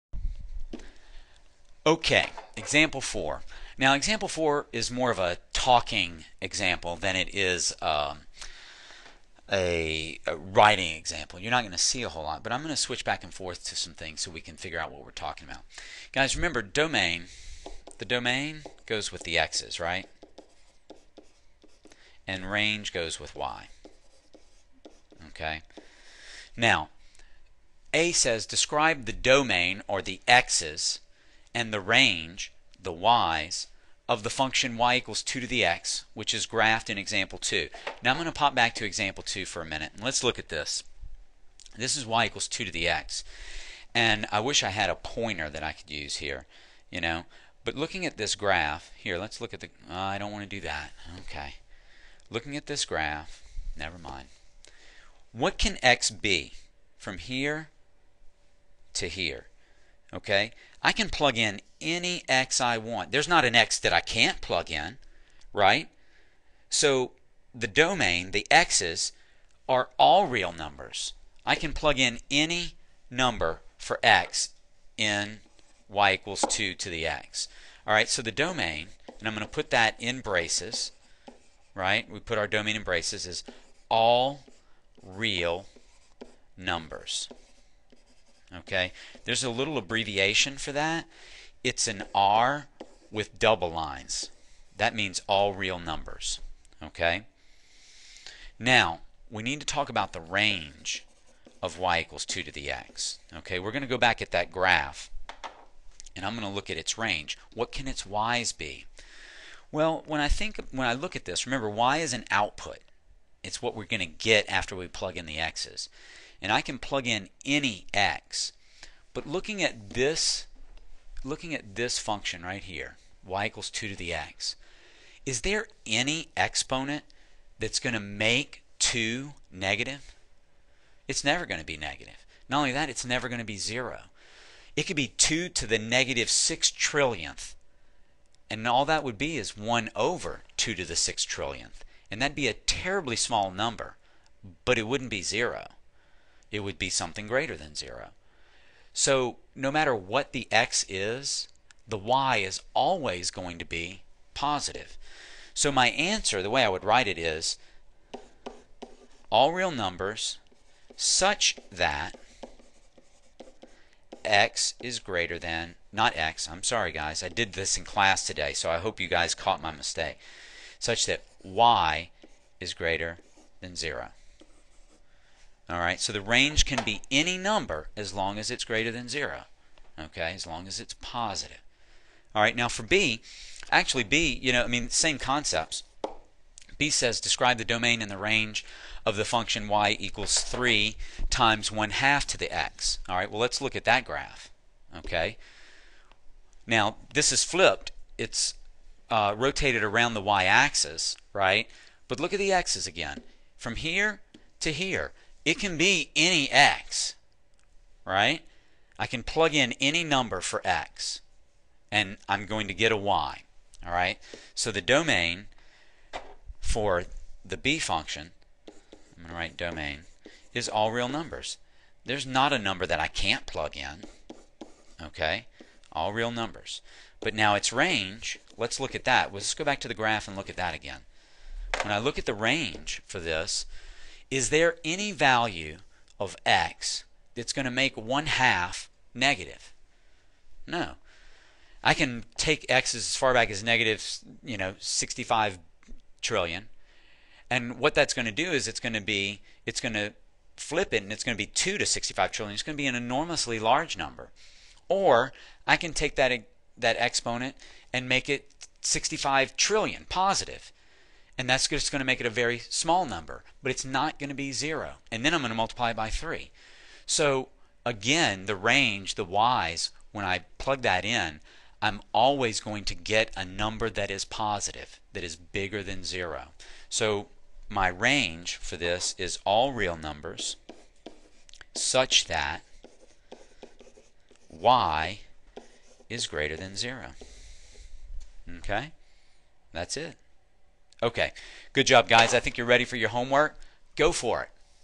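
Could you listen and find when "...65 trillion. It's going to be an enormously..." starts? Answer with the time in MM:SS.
04:11.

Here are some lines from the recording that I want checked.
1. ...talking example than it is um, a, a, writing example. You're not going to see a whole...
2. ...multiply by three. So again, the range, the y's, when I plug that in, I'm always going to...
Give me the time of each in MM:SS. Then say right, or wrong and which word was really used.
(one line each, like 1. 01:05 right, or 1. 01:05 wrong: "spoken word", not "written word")
1. 00:05 right
2. 04:25 right.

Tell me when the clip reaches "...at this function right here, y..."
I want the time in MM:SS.
02:01.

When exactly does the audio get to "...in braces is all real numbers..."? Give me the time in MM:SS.
01:22.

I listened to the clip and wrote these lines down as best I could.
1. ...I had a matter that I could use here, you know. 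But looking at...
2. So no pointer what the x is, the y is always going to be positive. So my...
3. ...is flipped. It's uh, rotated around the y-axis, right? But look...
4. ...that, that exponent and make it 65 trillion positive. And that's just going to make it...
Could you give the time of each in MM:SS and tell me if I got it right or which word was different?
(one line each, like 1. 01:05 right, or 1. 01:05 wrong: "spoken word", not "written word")
1. 00:44 wrong: "pointer", not "matter"
2. 02:28 wrong: "matter", not "pointer"
3. 03:17 right
4. 04:16 right.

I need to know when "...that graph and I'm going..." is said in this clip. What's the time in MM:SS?
01:44.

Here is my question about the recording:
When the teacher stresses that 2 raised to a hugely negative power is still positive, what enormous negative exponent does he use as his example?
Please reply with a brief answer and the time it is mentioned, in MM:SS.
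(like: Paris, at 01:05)
-6 trillion, at 02:15.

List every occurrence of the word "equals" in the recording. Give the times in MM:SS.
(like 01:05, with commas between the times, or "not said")
00:34, 00:42, 01:16, 01:42, 02:03, 03:09.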